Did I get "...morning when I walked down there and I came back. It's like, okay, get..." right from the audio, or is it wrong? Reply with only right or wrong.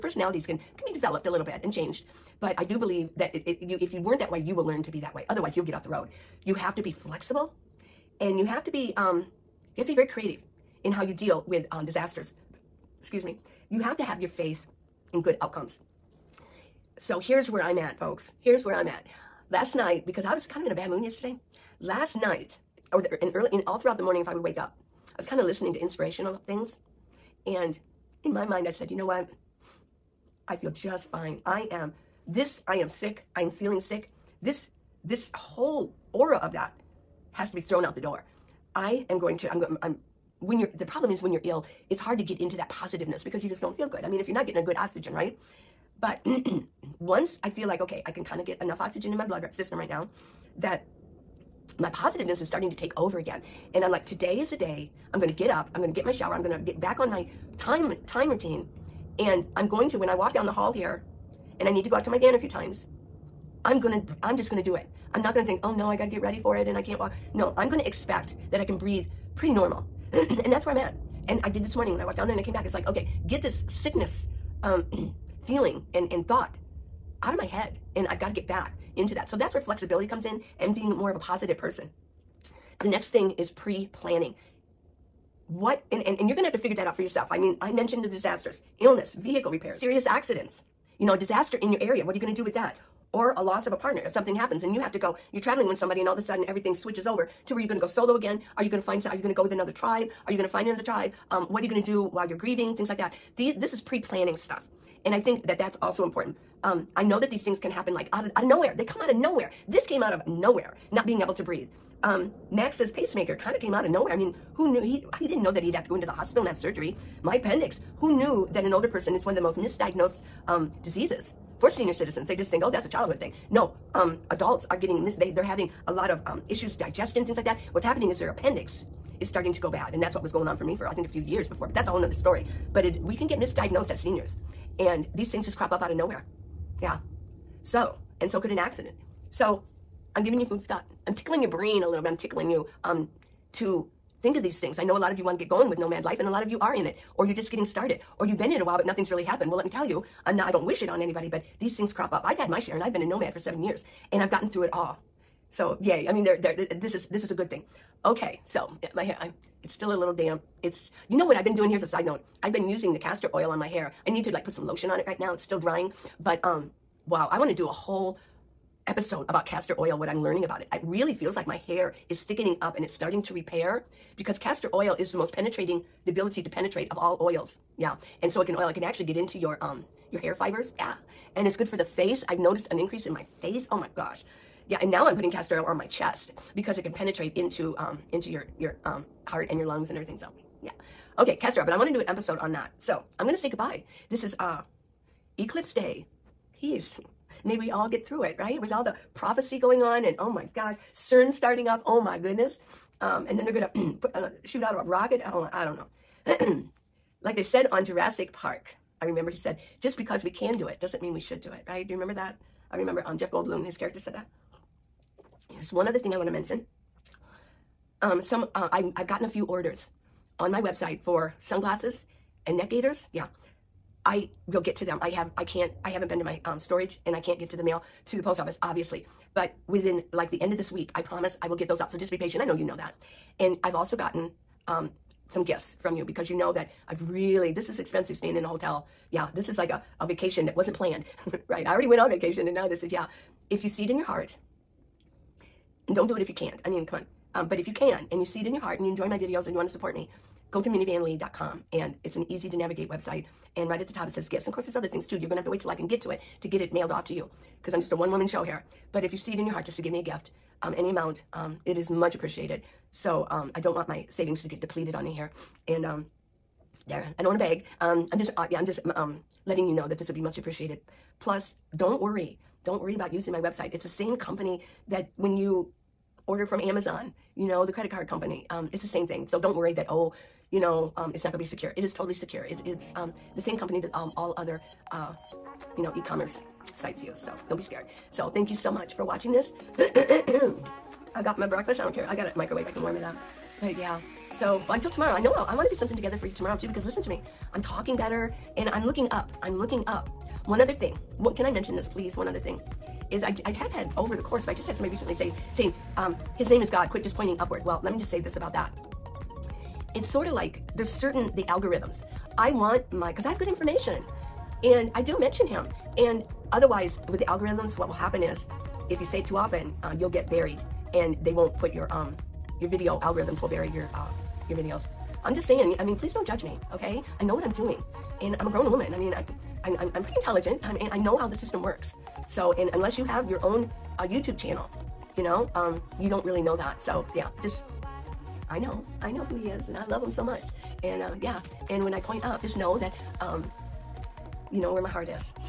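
right.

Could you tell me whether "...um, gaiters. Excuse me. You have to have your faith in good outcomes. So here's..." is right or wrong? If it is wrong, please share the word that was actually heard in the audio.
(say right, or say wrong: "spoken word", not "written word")
wrong: "disasters", not "gaiters".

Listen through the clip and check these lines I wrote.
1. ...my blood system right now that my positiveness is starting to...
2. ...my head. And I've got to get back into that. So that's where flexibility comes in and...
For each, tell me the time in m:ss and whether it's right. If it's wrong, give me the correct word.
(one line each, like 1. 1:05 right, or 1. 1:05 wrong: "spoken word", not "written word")
1. 0:49 right
2. 1:17 right.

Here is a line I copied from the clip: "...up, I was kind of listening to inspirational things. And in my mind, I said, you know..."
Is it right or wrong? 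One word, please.
right.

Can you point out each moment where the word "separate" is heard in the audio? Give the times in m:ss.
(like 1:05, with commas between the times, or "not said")
not said.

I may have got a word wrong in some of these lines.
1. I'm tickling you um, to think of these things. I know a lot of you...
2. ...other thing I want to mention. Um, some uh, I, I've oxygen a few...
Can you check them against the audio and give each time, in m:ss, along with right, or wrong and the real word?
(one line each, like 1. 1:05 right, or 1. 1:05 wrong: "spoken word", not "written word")
1. 2:22 right
2. 3:35 wrong: "gotten", not "oxygen".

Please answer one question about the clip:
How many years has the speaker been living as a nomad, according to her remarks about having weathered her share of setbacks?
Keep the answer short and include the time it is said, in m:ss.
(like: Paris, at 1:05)
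7, at 2:33.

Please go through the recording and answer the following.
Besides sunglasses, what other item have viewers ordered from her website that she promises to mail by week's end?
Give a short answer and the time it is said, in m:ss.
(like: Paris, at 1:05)
Neck gaiters, at 3:42.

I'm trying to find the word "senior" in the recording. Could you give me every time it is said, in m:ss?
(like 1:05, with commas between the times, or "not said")
2:01, 2:13.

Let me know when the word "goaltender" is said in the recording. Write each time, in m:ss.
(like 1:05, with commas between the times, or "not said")
not said.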